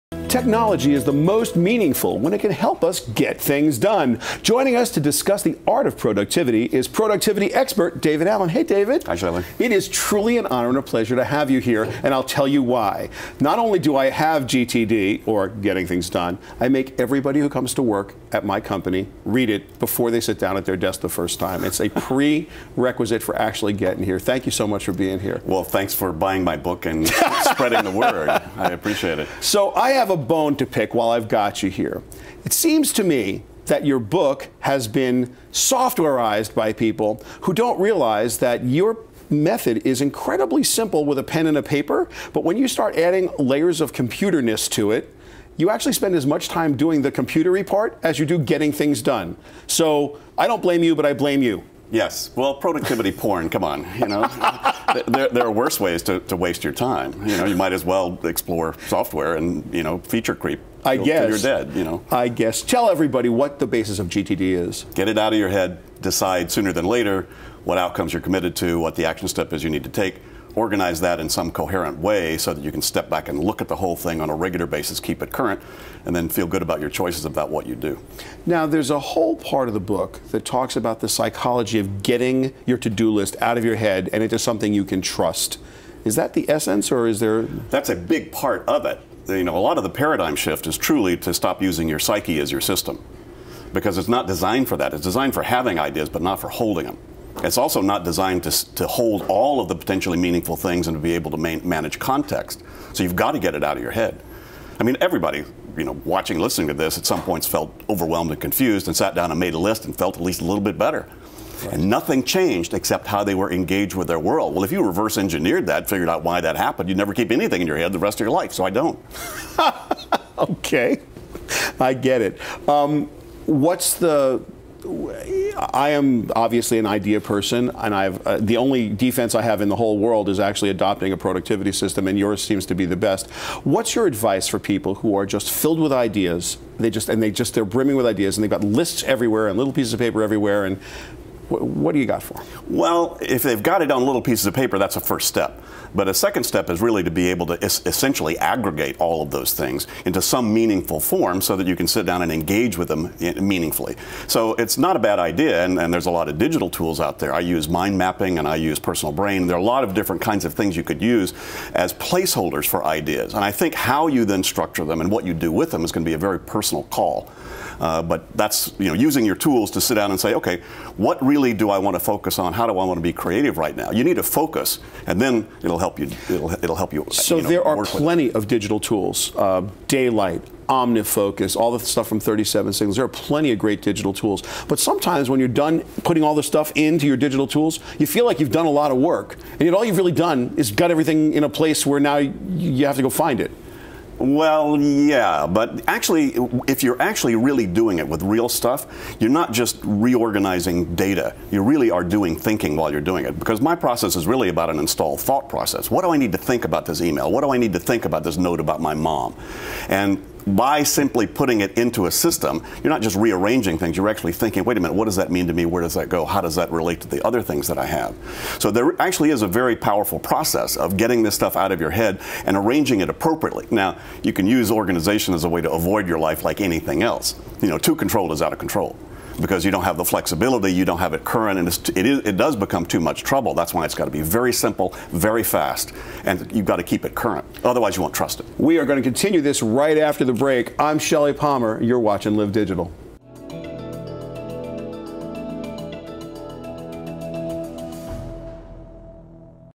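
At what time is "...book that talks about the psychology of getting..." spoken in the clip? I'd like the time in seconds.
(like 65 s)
79 s.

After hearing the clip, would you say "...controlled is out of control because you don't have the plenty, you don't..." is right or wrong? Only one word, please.
wrong.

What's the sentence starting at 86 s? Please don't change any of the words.
Is that the essence, or is there?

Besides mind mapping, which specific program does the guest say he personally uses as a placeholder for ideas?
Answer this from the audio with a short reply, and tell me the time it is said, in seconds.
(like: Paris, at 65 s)
PersonalBrain, at 158 s.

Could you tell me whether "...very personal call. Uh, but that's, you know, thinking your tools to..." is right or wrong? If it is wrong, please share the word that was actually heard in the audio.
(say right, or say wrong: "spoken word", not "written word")
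wrong: "using", not "thinking".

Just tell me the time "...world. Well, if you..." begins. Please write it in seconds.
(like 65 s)
114 s.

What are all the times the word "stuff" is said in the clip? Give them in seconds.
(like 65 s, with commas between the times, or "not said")
181 s, 186 s, 198 s, 221 s.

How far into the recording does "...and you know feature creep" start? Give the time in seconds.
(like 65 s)
59 s.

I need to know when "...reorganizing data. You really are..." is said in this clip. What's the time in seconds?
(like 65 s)
199 s.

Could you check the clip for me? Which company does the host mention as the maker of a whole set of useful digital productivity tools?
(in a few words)
37 Signals.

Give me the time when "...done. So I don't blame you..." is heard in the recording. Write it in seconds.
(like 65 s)
49 s.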